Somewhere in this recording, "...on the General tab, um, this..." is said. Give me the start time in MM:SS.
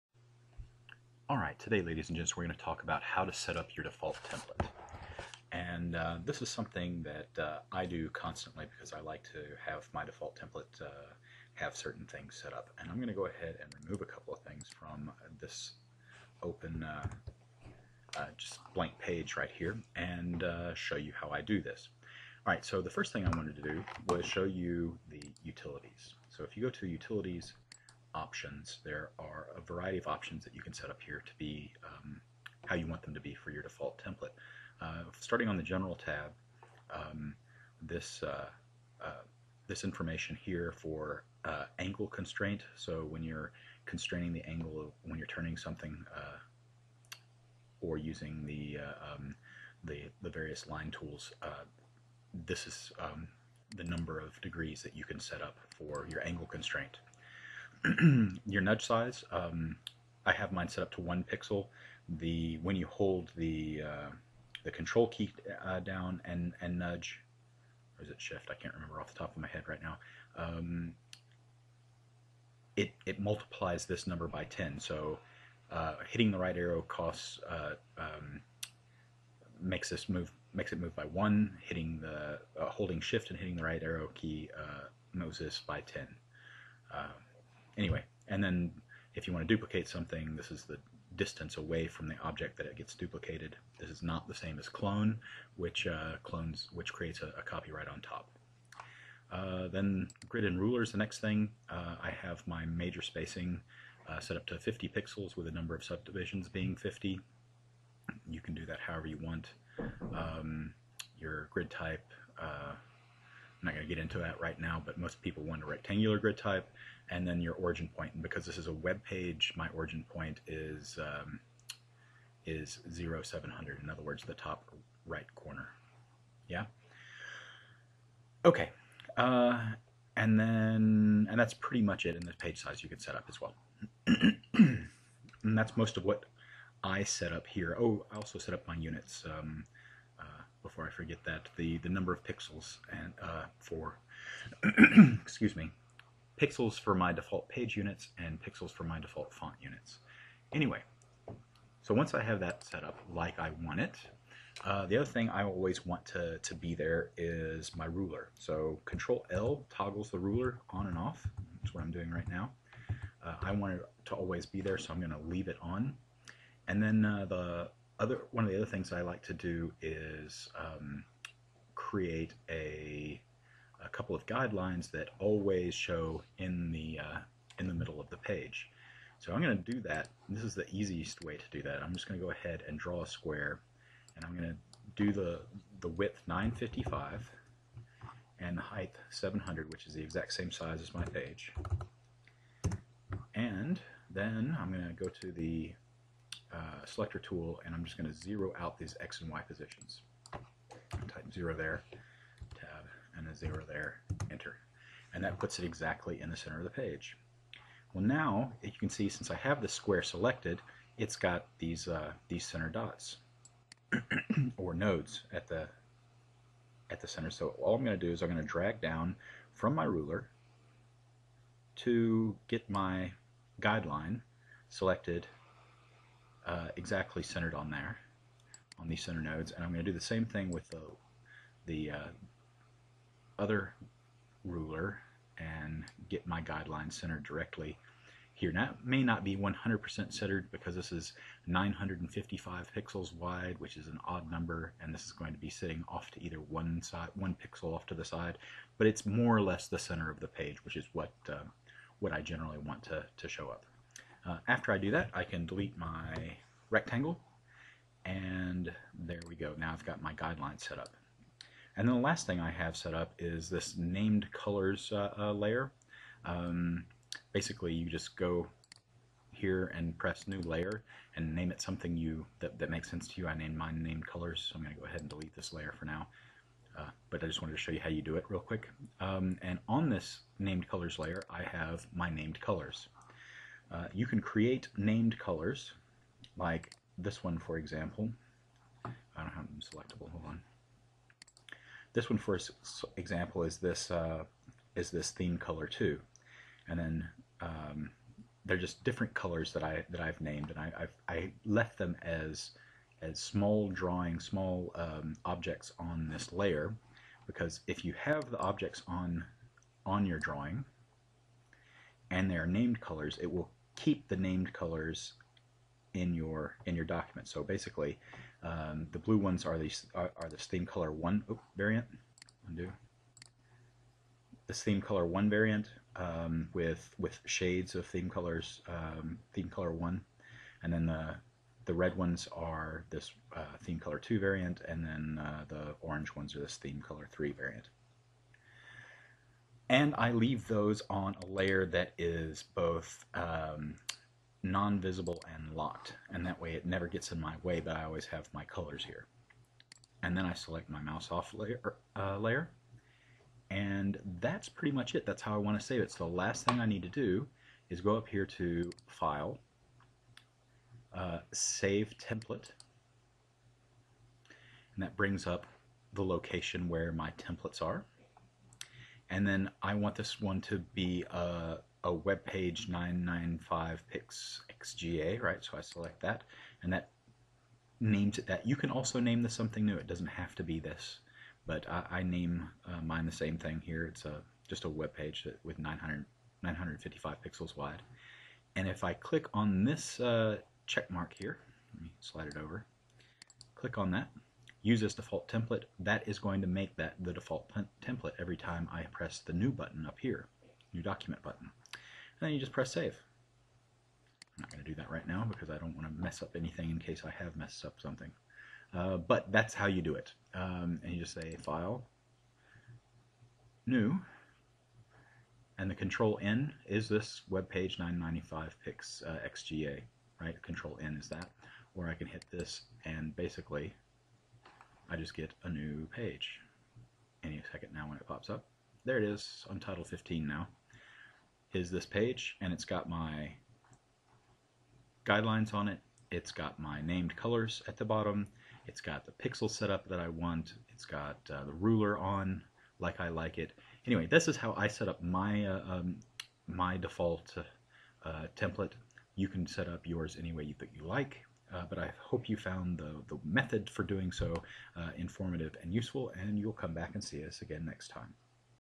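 00:35.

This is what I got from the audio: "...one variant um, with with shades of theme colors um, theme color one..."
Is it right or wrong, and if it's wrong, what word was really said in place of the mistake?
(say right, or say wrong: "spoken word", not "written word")
right.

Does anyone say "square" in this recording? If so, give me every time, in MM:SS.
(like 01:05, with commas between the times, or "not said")
03:03, 03:29.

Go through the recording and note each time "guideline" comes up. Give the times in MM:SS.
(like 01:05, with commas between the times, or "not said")
02:54, 03:43, 03:56, 04:20, 07:15.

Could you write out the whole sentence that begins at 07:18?
It's got the pixel setup that I want.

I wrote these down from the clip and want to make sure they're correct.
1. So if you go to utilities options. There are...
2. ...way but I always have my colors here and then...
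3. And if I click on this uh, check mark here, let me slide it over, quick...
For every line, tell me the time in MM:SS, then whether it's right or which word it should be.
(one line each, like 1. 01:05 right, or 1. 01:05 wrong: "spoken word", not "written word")
1. 00:26 right
2. 05:47 right
3. 06:28 wrong: "click", not "quick".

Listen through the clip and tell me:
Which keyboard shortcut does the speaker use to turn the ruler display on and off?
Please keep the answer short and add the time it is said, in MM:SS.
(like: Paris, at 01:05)
Control L, at 02:38.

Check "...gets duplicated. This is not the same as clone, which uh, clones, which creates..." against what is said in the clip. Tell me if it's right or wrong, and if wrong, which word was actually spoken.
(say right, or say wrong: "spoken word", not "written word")
right.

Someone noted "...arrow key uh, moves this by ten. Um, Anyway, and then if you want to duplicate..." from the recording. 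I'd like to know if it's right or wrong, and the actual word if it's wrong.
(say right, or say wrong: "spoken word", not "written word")
right.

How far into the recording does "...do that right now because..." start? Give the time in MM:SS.
06:44.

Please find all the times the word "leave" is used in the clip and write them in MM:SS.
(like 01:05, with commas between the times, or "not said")
02:45, 05:40.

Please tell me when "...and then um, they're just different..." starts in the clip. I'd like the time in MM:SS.
04:56.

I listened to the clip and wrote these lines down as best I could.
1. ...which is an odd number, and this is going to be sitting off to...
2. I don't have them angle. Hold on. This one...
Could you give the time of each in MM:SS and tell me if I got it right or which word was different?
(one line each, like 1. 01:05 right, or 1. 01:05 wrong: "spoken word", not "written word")
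1. 04:03 right
2. 04:48 wrong: "selectable", not "angle".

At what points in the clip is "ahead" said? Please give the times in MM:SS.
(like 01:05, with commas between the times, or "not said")
00:13, 03:02, 04:34.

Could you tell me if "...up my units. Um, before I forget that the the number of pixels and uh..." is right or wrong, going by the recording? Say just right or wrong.
right.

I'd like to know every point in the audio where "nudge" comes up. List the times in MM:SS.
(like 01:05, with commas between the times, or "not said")
00:58, 01:06.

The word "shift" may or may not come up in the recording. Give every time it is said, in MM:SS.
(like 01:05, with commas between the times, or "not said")
01:08, 01:22.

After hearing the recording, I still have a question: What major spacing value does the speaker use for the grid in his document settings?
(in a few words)
50 pixels.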